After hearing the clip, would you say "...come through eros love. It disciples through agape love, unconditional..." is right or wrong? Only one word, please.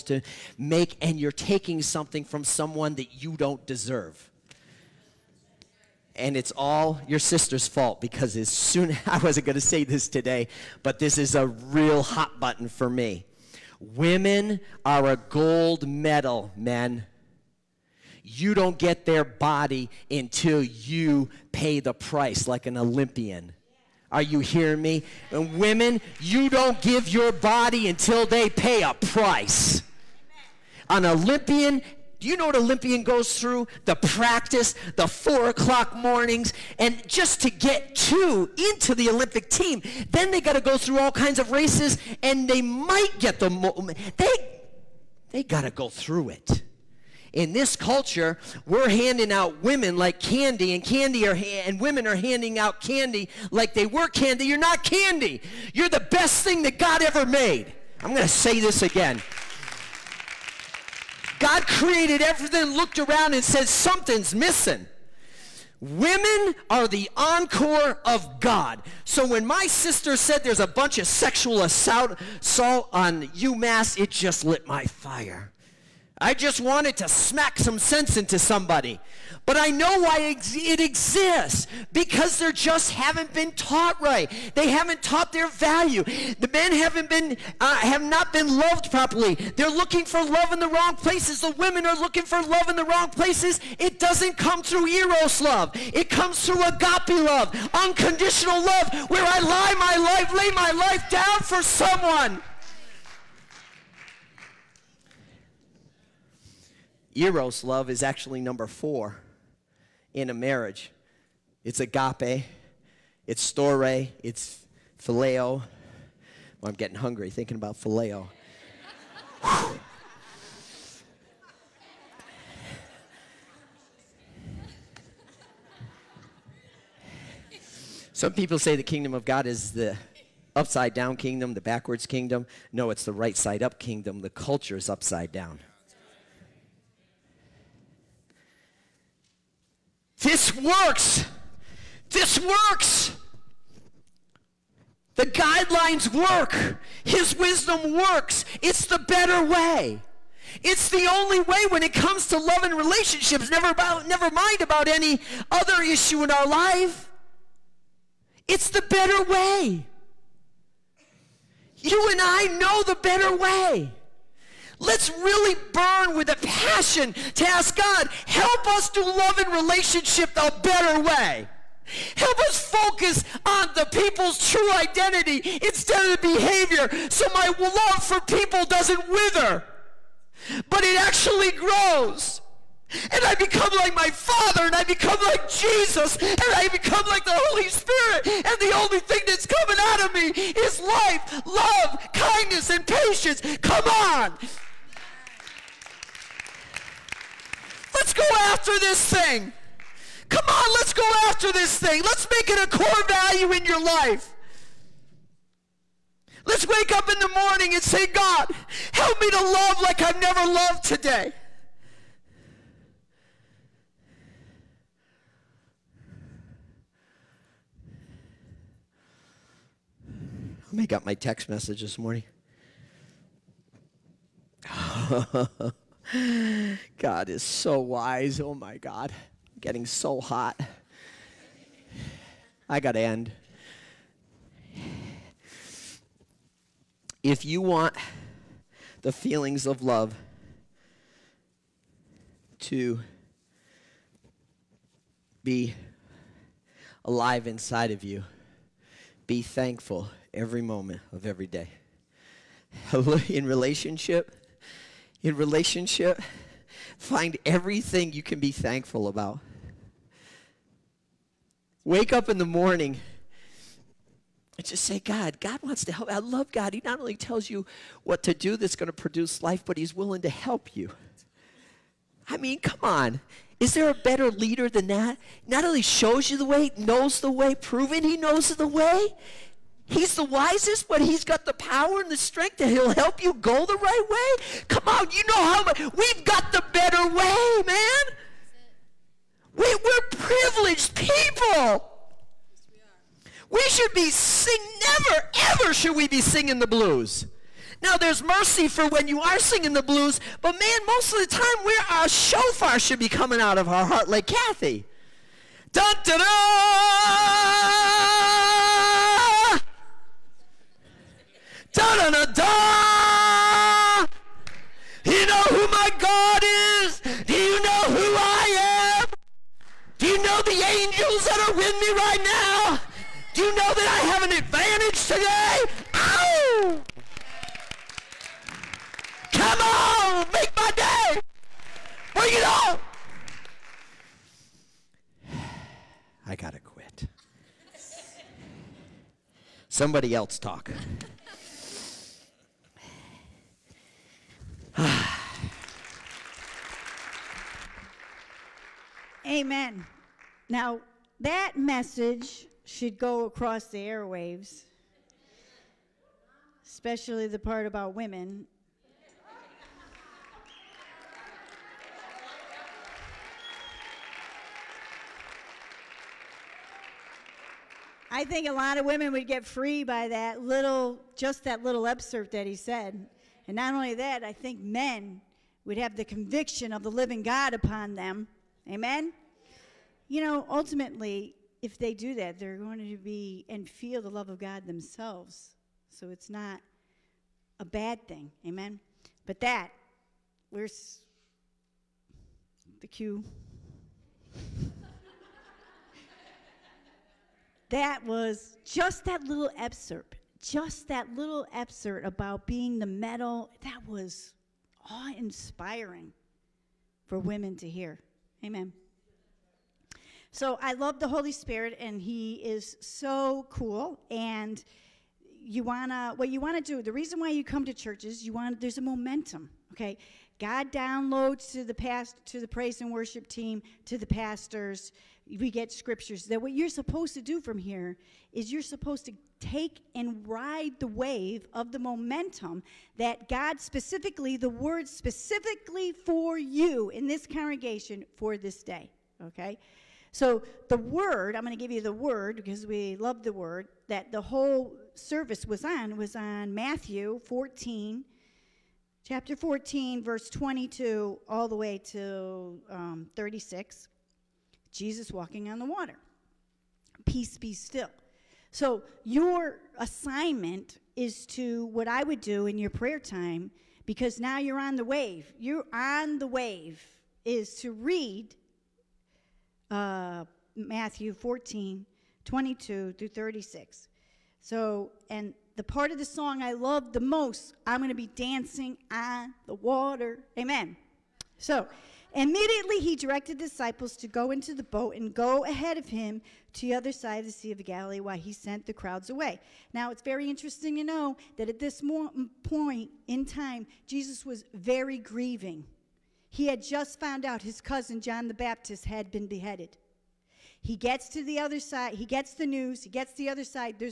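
wrong.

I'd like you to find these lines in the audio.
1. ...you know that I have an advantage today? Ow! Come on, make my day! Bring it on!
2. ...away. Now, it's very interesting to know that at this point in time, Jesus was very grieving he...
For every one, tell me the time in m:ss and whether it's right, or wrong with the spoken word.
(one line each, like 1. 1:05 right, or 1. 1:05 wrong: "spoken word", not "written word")
1. 5:23 right
2. 8:09 right.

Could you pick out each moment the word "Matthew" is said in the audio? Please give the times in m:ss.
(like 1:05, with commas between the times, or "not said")
7:26, 7:50.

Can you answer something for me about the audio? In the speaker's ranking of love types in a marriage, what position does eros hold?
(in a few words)
Number 4.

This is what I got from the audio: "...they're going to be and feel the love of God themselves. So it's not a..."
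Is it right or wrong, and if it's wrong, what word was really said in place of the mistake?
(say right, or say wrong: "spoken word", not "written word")
right.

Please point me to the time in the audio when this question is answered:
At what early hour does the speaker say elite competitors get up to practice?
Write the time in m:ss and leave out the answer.
0:35.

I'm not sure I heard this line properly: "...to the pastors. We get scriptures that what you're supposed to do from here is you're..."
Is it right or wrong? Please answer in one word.
right.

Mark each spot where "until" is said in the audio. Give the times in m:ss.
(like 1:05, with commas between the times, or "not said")
0:20, 0:27.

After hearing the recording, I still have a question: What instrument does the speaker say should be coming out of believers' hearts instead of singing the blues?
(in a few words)
Shofar.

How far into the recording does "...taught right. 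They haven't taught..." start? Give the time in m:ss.
1:23.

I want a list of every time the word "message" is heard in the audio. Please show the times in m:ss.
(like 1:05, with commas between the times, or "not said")
3:41, 5:51.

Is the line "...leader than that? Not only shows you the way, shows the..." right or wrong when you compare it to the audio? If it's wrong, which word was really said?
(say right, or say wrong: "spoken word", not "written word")
wrong: "knows", not "shows".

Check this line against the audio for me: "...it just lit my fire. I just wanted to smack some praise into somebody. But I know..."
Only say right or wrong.
wrong.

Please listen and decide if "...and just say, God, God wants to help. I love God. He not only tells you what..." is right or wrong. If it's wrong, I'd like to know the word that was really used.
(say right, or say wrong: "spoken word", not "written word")
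right.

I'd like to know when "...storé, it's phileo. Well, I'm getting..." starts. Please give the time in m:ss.
1:53.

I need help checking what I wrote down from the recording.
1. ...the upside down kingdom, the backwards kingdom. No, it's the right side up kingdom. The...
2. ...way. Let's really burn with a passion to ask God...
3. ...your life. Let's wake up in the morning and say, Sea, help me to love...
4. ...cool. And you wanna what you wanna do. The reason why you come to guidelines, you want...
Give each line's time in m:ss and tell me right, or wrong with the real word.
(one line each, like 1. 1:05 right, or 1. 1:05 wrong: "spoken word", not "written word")
1. 2:09 right
2. 2:43 right
3. 3:23 wrong: "God", not "Sea"
4. 6:53 wrong: "churches", not "guidelines".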